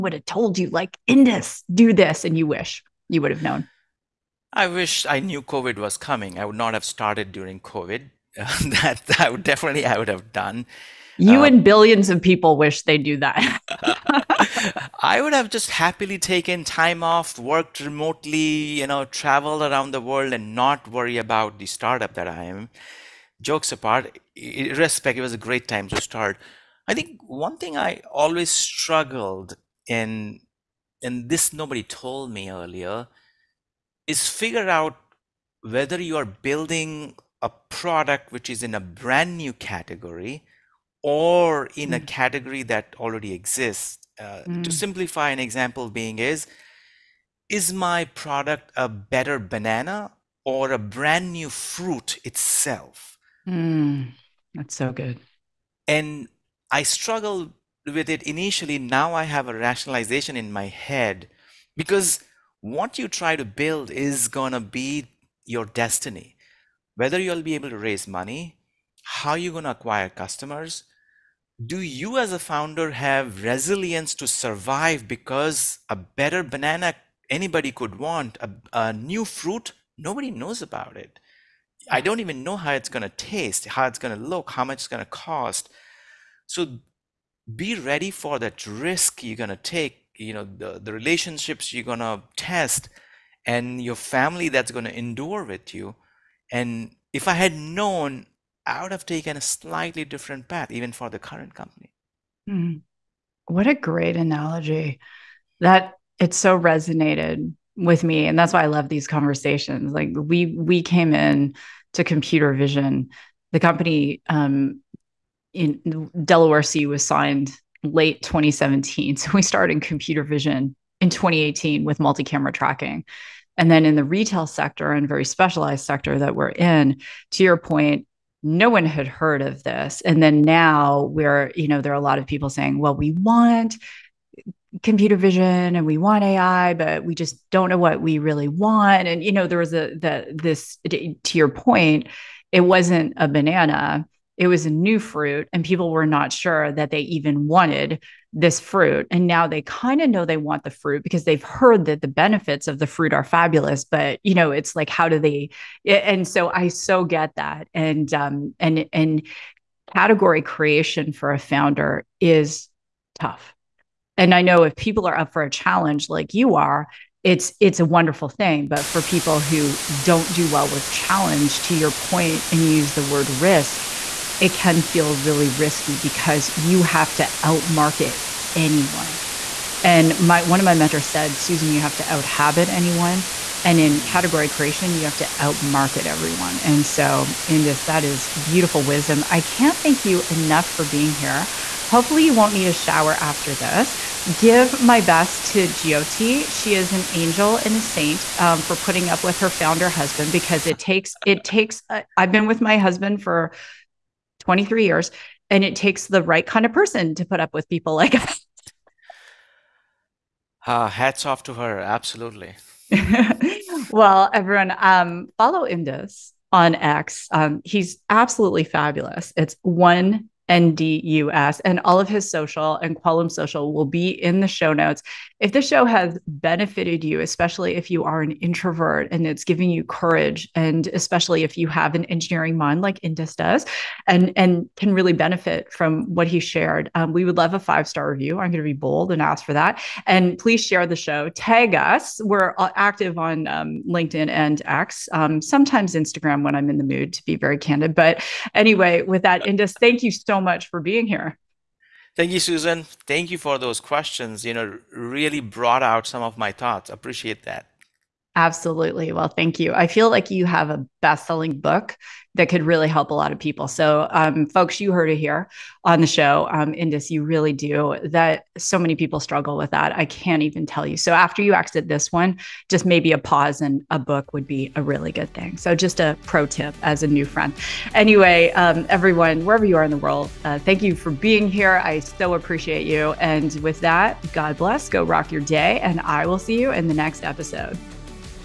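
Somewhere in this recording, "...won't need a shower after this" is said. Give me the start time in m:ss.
3:12.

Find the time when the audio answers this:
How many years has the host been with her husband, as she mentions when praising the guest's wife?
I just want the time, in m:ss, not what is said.
3:24.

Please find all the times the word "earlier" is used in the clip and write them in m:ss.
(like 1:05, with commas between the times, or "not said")
0:32.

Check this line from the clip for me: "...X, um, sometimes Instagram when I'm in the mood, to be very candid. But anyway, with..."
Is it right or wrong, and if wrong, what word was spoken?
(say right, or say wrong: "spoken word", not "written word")
right.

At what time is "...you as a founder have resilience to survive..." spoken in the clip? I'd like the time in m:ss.
1:11.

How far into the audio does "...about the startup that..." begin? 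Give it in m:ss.
0:21.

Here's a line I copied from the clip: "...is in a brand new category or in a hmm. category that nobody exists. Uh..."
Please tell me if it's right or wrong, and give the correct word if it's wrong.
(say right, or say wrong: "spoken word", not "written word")
wrong: "already", not "nobody".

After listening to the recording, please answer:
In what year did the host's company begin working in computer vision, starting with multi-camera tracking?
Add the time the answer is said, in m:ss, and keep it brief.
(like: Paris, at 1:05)
2018, at 2:01.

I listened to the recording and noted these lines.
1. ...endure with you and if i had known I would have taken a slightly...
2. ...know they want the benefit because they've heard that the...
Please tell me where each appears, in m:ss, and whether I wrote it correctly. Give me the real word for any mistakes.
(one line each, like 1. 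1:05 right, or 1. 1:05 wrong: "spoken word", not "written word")
1. 1:34 right
2. 2:30 wrong: "fruit", not "benefit".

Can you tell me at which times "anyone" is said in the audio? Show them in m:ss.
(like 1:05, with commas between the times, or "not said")
2:58, 3:02.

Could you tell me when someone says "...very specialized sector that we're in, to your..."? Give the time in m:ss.
2:05.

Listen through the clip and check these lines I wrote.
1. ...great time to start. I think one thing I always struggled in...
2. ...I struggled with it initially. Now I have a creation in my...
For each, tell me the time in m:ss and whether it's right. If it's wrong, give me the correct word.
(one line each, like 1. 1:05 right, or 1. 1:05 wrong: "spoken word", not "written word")
1. 0:25 right
2. 0:56 wrong: "rationalization", not "creation".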